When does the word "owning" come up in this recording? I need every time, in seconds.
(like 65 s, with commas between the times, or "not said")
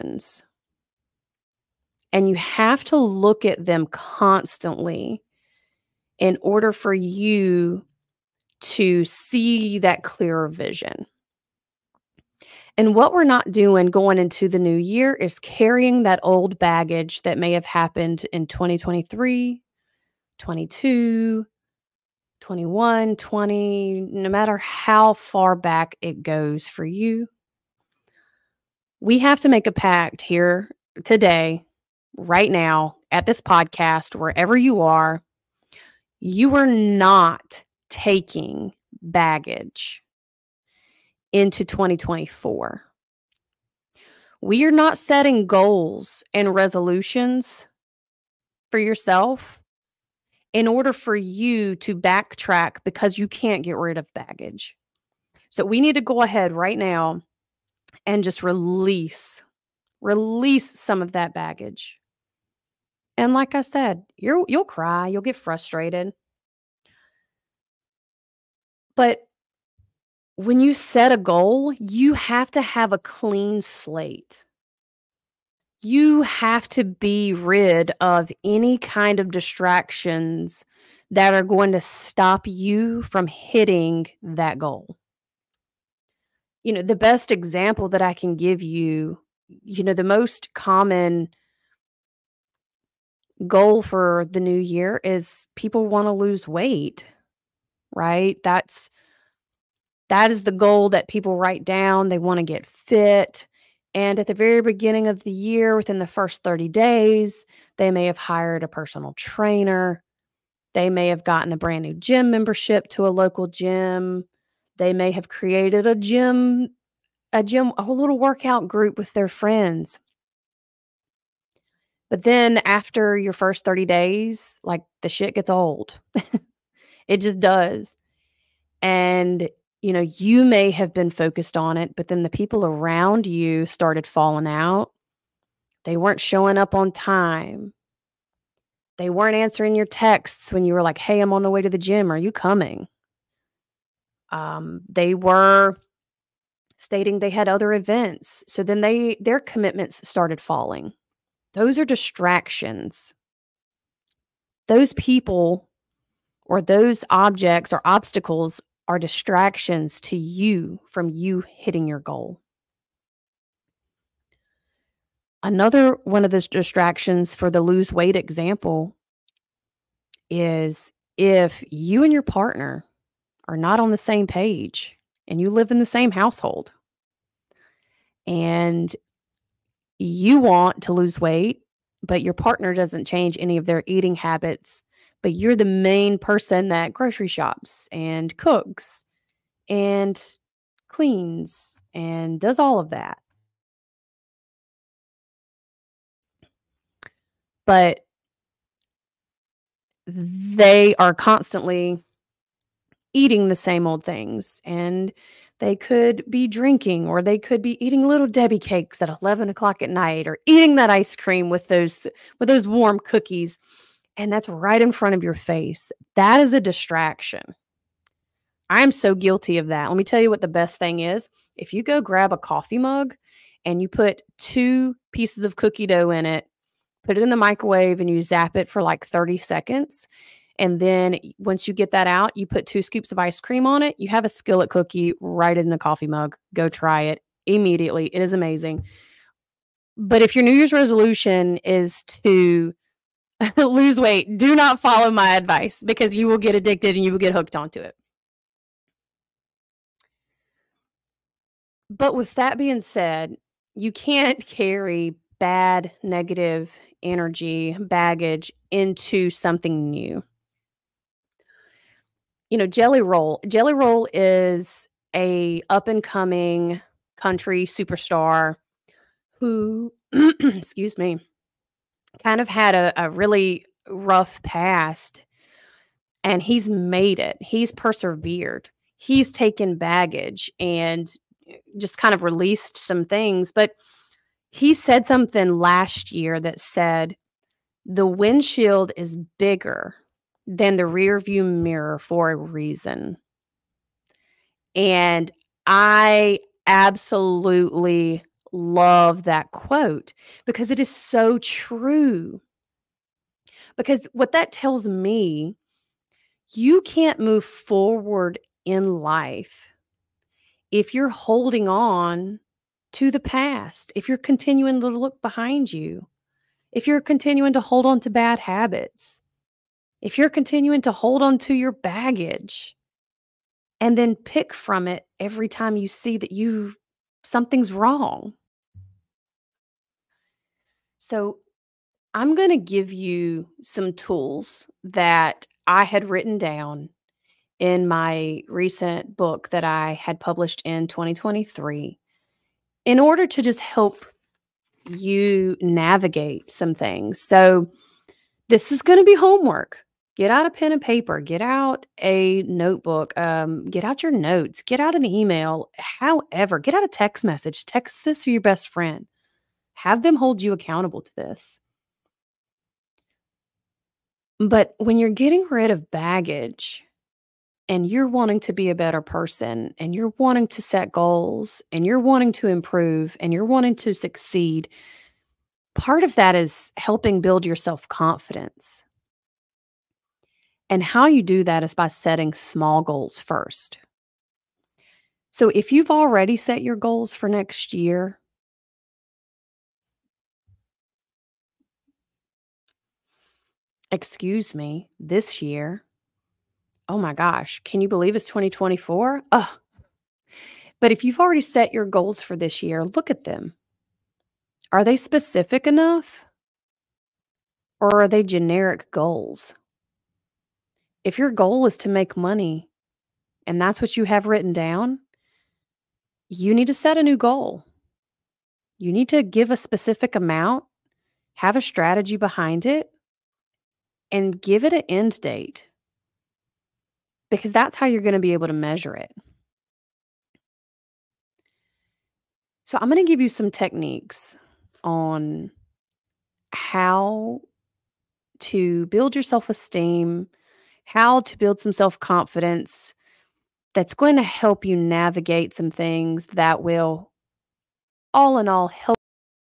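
not said.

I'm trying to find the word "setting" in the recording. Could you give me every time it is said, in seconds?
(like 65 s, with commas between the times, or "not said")
44 s, 381 s.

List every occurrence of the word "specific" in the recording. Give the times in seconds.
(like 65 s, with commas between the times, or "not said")
404 s, 419 s.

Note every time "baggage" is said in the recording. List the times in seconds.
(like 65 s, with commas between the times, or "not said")
16 s, 39 s, 54 s, 61 s, 257 s, 279 s, 321 s, 365 s.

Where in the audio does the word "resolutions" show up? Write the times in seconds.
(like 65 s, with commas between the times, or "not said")
46 s, 240 s.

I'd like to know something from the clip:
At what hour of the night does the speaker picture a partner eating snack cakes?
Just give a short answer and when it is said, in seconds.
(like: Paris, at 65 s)
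11 o'clock, at 209 s.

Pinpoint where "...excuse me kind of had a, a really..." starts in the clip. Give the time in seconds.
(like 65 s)
270 s.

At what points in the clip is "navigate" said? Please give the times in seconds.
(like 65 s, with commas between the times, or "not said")
345 s, 444 s.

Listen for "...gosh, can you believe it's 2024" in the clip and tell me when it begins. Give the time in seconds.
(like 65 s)
397 s.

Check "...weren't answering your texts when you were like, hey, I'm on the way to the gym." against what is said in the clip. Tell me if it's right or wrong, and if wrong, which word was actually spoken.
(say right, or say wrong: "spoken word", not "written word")
right.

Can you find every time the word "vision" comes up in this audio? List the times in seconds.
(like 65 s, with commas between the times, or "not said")
10 s.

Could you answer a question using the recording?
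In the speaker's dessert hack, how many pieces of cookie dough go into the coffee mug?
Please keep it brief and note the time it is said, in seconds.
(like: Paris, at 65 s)
2, at 224 s.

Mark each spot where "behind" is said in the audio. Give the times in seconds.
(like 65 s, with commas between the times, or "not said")
315 s, 422 s.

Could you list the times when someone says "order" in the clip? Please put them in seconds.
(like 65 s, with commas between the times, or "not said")
6 s, 50 s, 342 s.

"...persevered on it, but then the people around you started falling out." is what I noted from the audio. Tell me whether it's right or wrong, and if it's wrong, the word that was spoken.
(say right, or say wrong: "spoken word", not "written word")
wrong: "focused", not "persevered".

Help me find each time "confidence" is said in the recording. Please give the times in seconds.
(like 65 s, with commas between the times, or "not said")
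377 s, 441 s.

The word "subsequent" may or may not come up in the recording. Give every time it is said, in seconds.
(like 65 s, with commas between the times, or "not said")
not said.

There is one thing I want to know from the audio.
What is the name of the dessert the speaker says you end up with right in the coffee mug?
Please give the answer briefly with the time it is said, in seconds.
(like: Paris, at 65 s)
skillet cookie, at 234 s.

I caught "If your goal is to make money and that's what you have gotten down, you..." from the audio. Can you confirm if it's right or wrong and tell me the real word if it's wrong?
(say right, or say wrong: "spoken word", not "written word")
wrong: "written", not "gotten".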